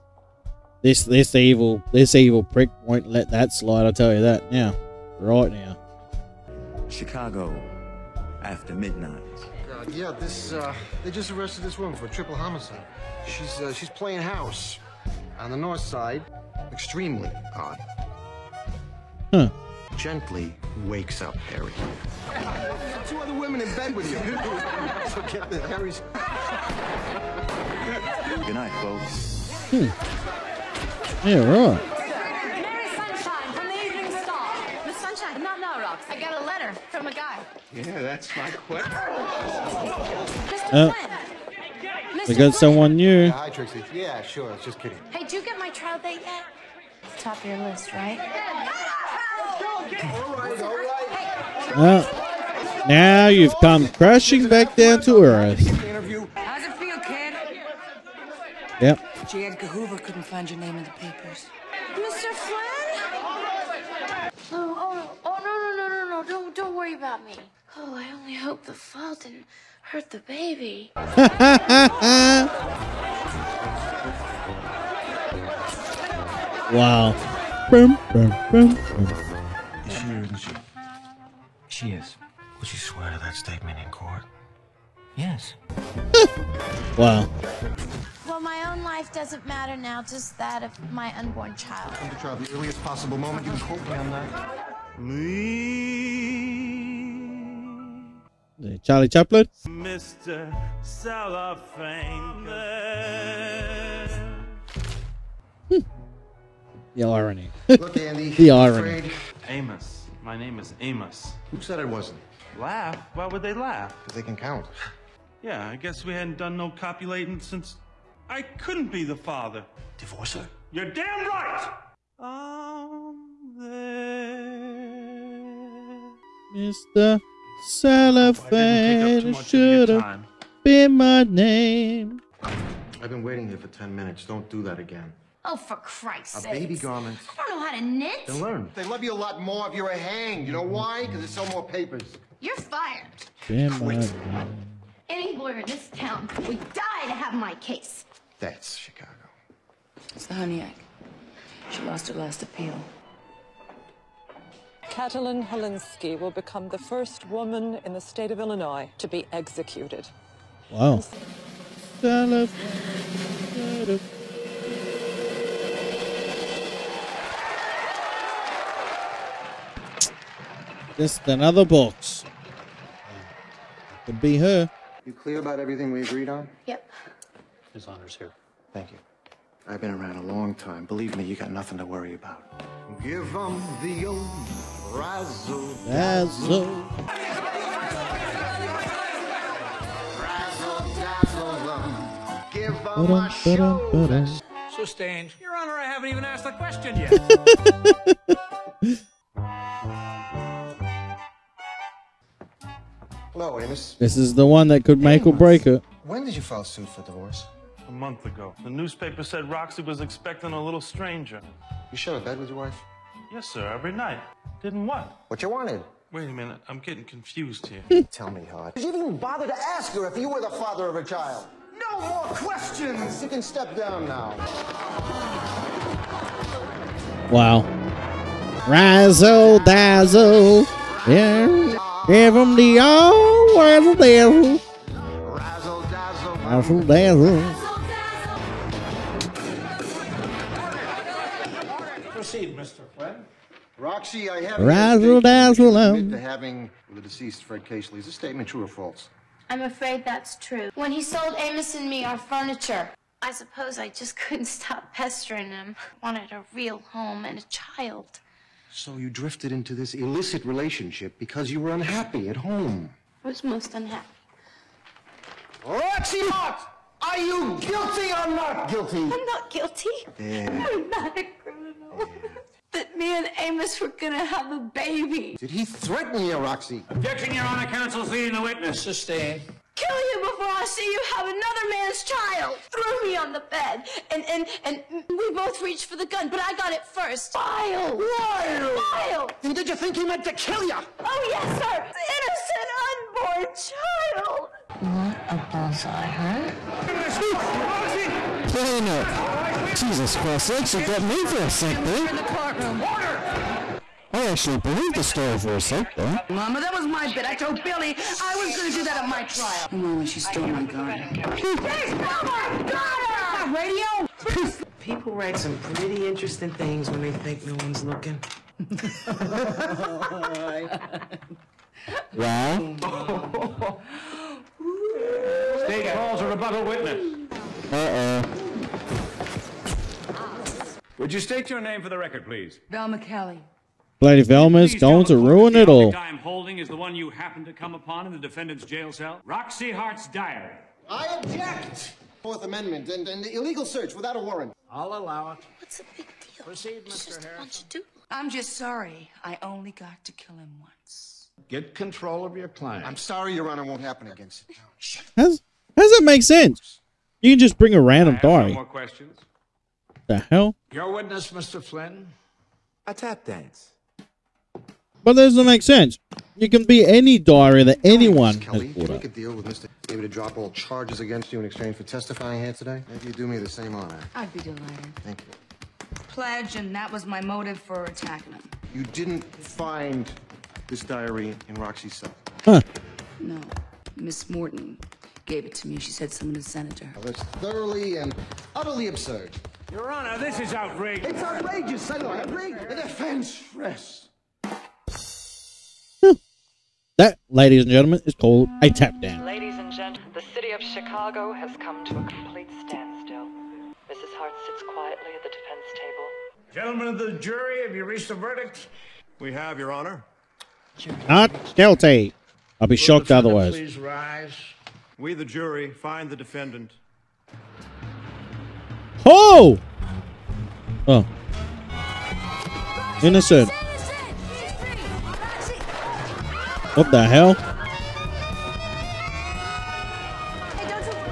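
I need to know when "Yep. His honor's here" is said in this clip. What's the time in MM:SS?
02:56.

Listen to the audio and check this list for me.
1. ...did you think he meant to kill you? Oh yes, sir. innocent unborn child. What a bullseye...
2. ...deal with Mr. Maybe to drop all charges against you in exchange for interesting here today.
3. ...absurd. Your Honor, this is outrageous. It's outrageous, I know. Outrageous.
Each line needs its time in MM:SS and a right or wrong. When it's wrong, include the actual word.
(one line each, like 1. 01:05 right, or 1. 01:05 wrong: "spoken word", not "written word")
1. 04:49 right
2. 06:09 wrong: "testifying", not "interesting"
3. 06:28 right.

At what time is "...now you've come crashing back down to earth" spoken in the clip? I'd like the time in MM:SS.
00:52.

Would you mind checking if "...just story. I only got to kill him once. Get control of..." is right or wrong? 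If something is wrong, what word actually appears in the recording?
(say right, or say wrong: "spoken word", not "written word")
wrong: "sorry", not "story".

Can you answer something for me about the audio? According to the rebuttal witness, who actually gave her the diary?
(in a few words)
Miss Morton.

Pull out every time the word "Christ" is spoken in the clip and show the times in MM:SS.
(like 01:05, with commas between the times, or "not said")
02:15, 05:00.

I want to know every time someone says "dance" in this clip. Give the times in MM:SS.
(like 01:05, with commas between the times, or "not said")
06:03, 06:39.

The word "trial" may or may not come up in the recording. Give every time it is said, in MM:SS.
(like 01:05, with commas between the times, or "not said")
00:45, 01:32, 05:09.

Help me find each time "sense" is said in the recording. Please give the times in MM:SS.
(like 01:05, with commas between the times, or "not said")
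05:56, 06:05.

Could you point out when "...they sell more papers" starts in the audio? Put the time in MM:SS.
02:21.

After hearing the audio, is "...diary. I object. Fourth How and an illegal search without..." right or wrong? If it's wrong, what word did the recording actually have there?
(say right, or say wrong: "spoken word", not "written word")
wrong: "Amendment", not "How".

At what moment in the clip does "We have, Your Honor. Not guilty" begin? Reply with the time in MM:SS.
06:49.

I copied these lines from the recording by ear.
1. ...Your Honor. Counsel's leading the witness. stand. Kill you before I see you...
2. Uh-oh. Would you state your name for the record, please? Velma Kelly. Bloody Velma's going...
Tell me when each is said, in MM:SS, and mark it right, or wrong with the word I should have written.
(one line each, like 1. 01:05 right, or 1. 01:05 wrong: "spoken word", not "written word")
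1. 04:37 right
2. 05:27 right.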